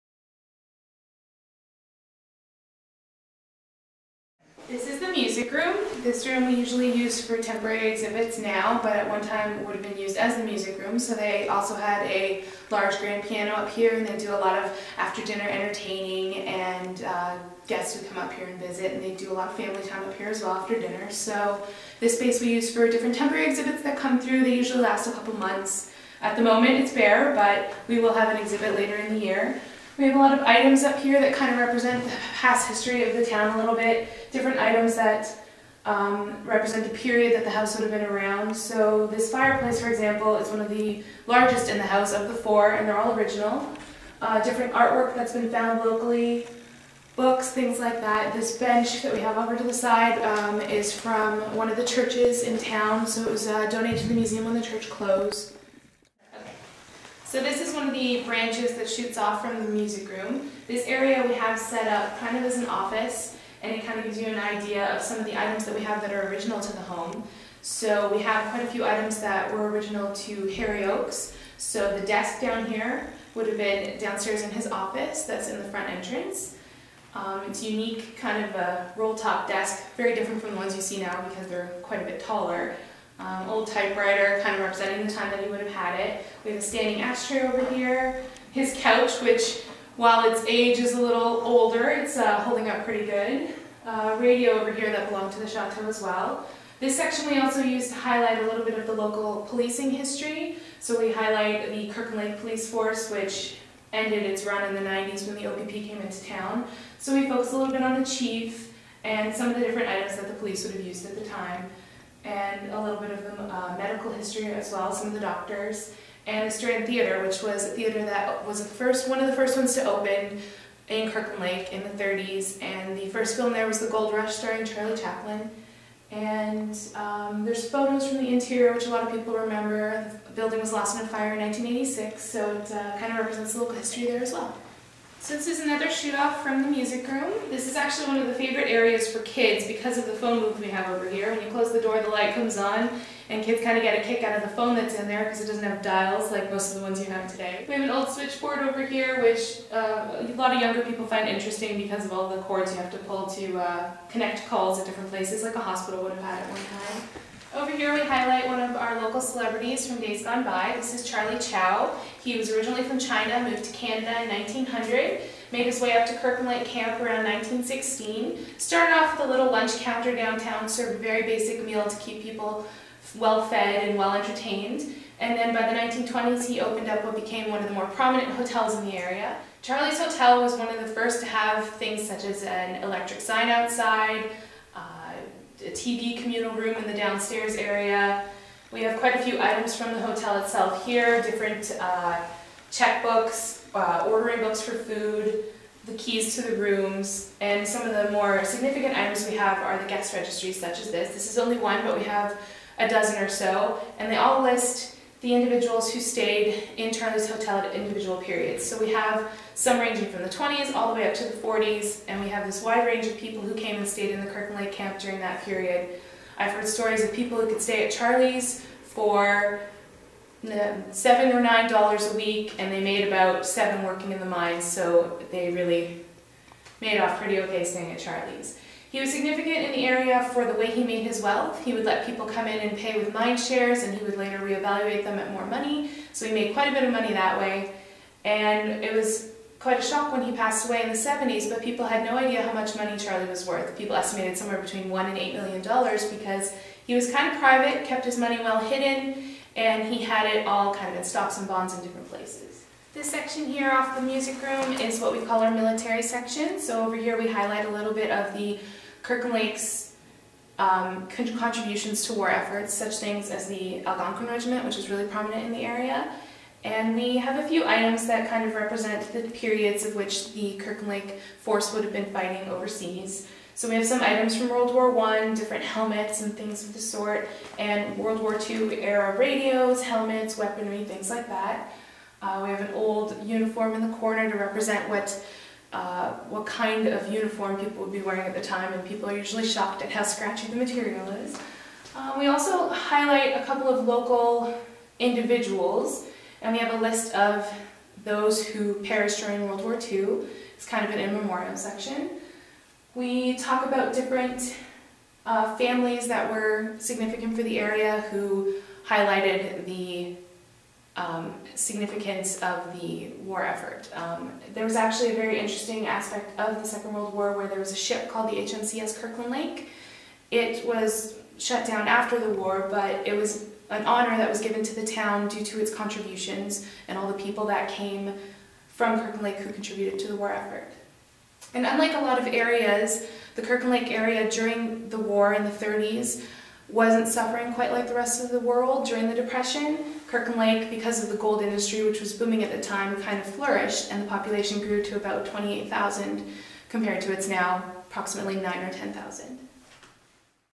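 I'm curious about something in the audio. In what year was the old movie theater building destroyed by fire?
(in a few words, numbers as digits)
1986.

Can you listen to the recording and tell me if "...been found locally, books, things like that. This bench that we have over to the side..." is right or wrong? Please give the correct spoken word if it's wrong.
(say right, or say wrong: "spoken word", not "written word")
right.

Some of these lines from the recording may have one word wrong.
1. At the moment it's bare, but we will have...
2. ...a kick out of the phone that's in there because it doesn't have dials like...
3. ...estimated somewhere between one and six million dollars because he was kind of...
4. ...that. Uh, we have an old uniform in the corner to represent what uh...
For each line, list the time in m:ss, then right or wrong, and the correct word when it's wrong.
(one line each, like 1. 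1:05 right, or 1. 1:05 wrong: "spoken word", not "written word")
1. 0:26 right
2. 2:23 right
3. 4:03 wrong: "eight", not "six"
4. 4:41 right.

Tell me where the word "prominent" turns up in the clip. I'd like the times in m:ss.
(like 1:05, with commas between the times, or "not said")
2:57, 4:25.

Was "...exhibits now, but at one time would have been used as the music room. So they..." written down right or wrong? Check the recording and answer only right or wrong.
right.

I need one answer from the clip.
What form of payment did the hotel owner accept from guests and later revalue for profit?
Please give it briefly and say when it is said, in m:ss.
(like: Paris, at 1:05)
mine shares, at 3:53.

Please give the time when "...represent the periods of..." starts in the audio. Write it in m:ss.
4:28.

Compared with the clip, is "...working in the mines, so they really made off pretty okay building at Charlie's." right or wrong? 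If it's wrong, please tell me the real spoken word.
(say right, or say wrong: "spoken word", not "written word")
wrong: "staying", not "building".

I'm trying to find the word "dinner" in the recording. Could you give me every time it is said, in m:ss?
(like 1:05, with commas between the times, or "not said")
0:15, 0:20.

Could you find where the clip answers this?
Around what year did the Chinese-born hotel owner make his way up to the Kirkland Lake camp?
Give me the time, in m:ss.
2:47.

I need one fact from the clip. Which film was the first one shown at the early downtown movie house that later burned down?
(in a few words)
The Gold Rush.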